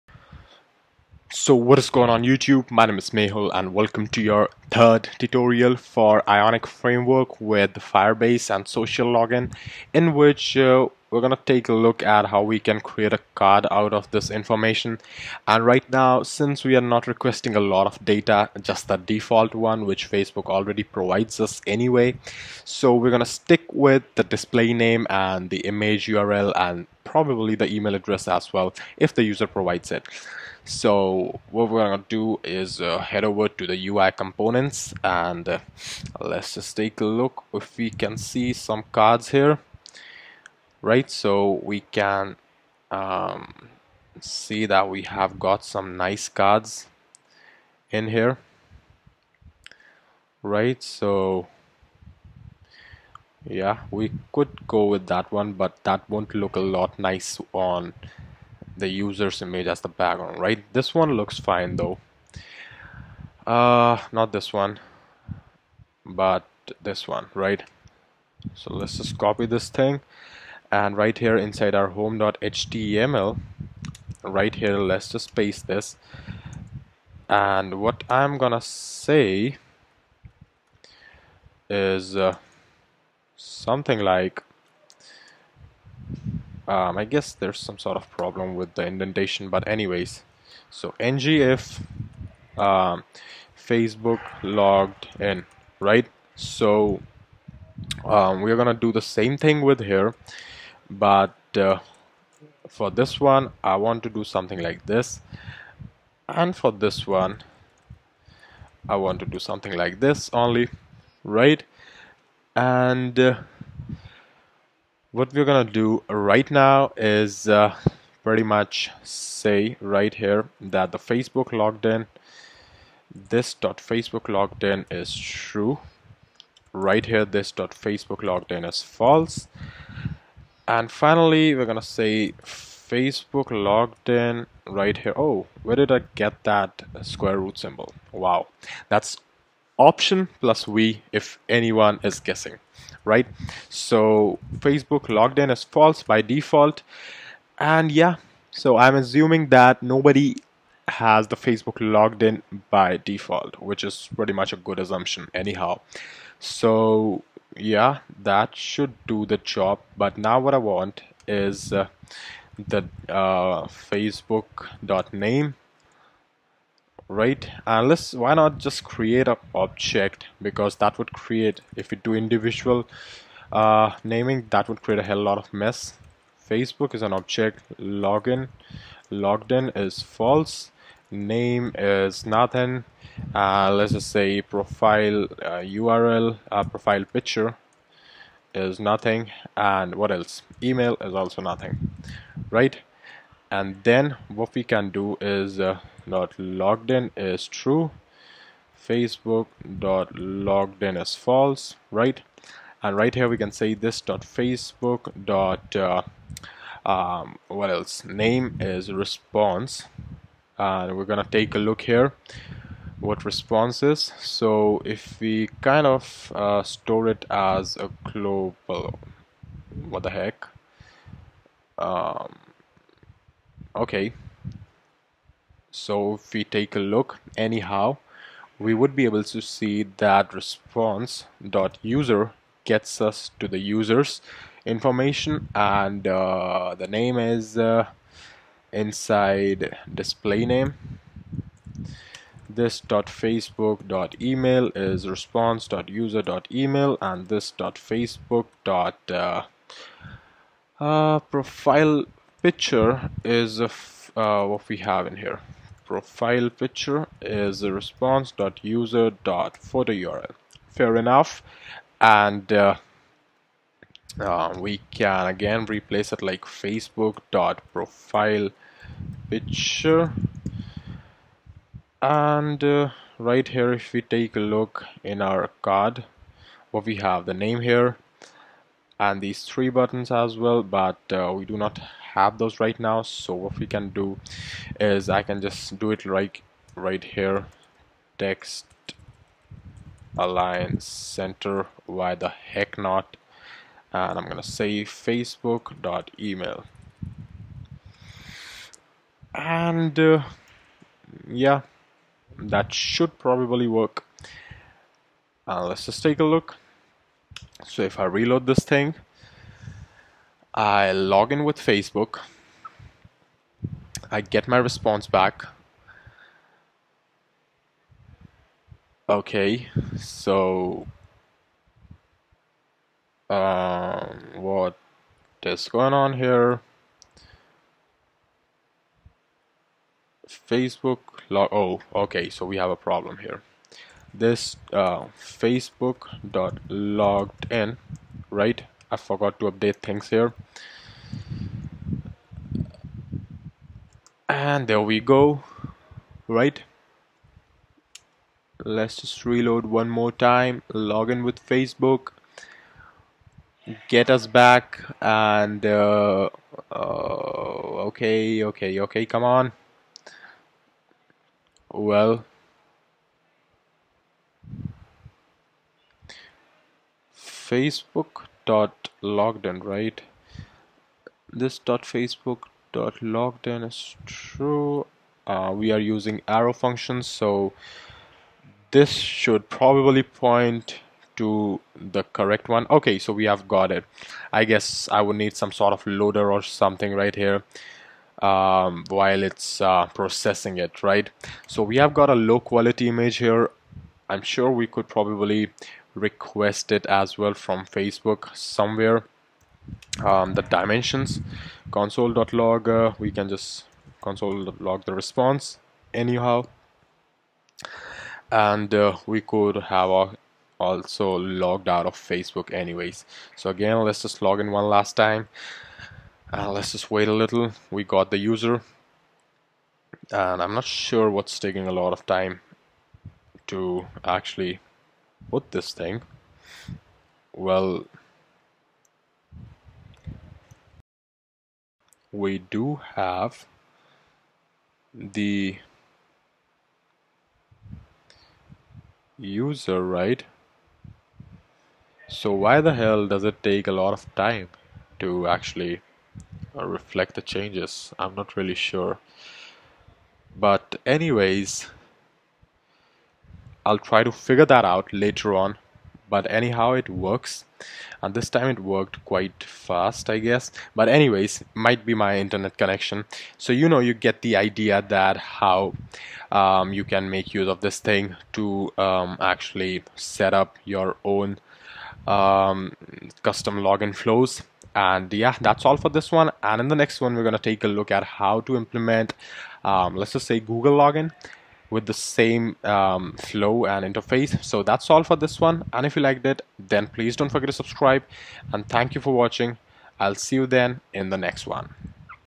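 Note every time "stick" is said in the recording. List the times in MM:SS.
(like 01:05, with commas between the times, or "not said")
00:23.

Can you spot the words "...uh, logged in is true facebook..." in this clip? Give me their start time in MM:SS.
03:16.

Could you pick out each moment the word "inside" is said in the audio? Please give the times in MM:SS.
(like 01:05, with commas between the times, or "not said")
01:11, 03:58.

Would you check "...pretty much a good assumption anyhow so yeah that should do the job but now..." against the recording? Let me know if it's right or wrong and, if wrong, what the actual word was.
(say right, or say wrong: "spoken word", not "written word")
right.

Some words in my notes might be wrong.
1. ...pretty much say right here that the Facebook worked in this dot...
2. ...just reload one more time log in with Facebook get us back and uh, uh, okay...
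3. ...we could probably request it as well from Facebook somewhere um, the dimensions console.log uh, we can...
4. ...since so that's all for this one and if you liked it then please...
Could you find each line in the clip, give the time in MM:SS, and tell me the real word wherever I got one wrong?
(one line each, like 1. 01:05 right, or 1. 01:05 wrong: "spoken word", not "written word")
1. 01:58 wrong: "logged", not "worked"
2. 05:48 right
3. 06:34 right
4. 08:03 wrong: "interface", not "since".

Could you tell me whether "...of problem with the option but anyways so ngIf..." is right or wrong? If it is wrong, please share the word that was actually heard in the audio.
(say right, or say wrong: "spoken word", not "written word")
wrong: "indentation", not "option".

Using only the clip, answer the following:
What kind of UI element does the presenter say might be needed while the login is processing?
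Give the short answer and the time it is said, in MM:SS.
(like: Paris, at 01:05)
loader, at 06:25.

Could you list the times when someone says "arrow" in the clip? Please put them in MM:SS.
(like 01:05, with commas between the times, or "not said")
06:16.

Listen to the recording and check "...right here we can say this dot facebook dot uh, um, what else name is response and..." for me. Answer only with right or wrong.
right.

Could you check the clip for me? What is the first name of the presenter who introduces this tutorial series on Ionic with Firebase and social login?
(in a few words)
Mehul.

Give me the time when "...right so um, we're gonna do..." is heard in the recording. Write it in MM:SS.
01:35.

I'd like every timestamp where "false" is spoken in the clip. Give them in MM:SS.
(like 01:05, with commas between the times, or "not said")
02:08, 02:25, 03:00, 03:21.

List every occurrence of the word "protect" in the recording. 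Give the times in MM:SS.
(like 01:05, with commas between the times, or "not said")
not said.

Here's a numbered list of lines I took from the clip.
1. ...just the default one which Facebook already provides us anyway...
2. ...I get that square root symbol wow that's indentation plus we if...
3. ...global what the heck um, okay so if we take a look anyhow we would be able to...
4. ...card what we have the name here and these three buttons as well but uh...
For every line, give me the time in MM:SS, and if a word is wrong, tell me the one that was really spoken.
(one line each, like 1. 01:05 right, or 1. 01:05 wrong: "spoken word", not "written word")
1. 00:18 right
2. 02:15 wrong: "option", not "indentation"
3. 03:38 right
4. 04:35 right.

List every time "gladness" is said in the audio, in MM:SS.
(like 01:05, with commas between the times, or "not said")
not said.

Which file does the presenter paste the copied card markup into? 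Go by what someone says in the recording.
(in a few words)
home.html.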